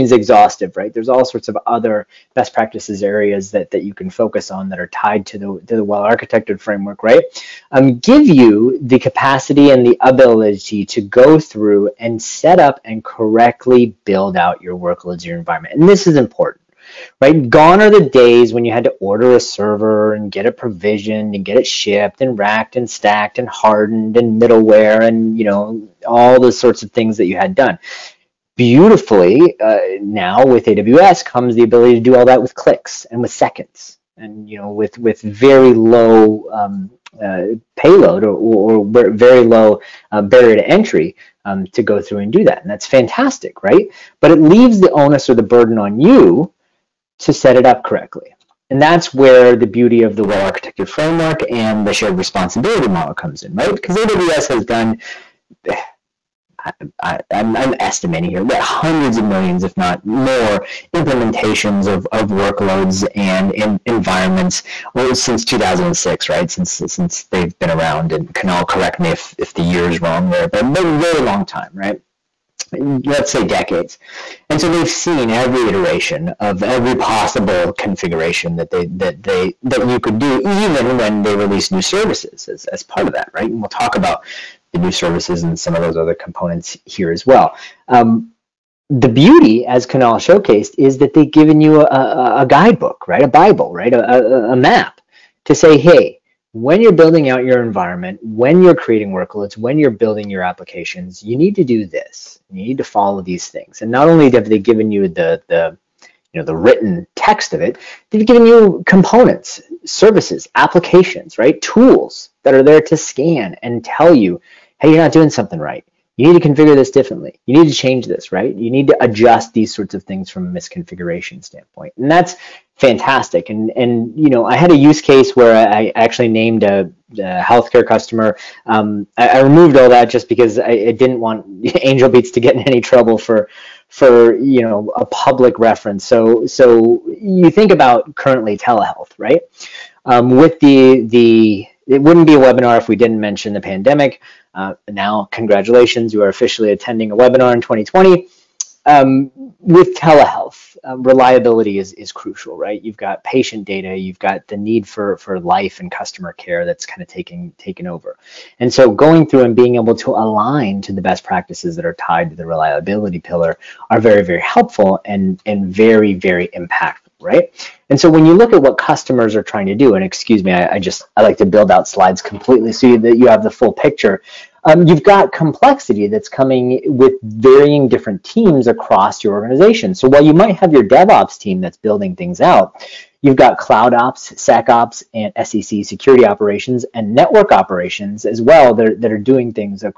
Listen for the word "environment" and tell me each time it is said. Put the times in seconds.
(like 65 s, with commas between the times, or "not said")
15 s, 63 s, 97 s.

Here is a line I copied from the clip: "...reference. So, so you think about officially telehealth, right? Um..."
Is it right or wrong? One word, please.
wrong.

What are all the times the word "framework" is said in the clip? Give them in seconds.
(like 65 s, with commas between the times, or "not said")
6 s, 50 s.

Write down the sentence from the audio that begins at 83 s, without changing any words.
And we'll talk about the new services and some of those other components here as well.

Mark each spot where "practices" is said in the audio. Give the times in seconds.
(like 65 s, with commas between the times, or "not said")
2 s, 161 s.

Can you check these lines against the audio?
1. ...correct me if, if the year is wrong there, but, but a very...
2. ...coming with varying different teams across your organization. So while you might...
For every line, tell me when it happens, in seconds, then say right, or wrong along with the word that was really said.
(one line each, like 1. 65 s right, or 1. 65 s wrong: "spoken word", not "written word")
1. 68 s right
2. 176 s right.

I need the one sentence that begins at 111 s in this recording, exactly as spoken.
Tools that are there to scan and tell you, hey, you're not doing something right you need to configure this differently.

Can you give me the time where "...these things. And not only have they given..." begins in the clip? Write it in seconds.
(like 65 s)
103 s.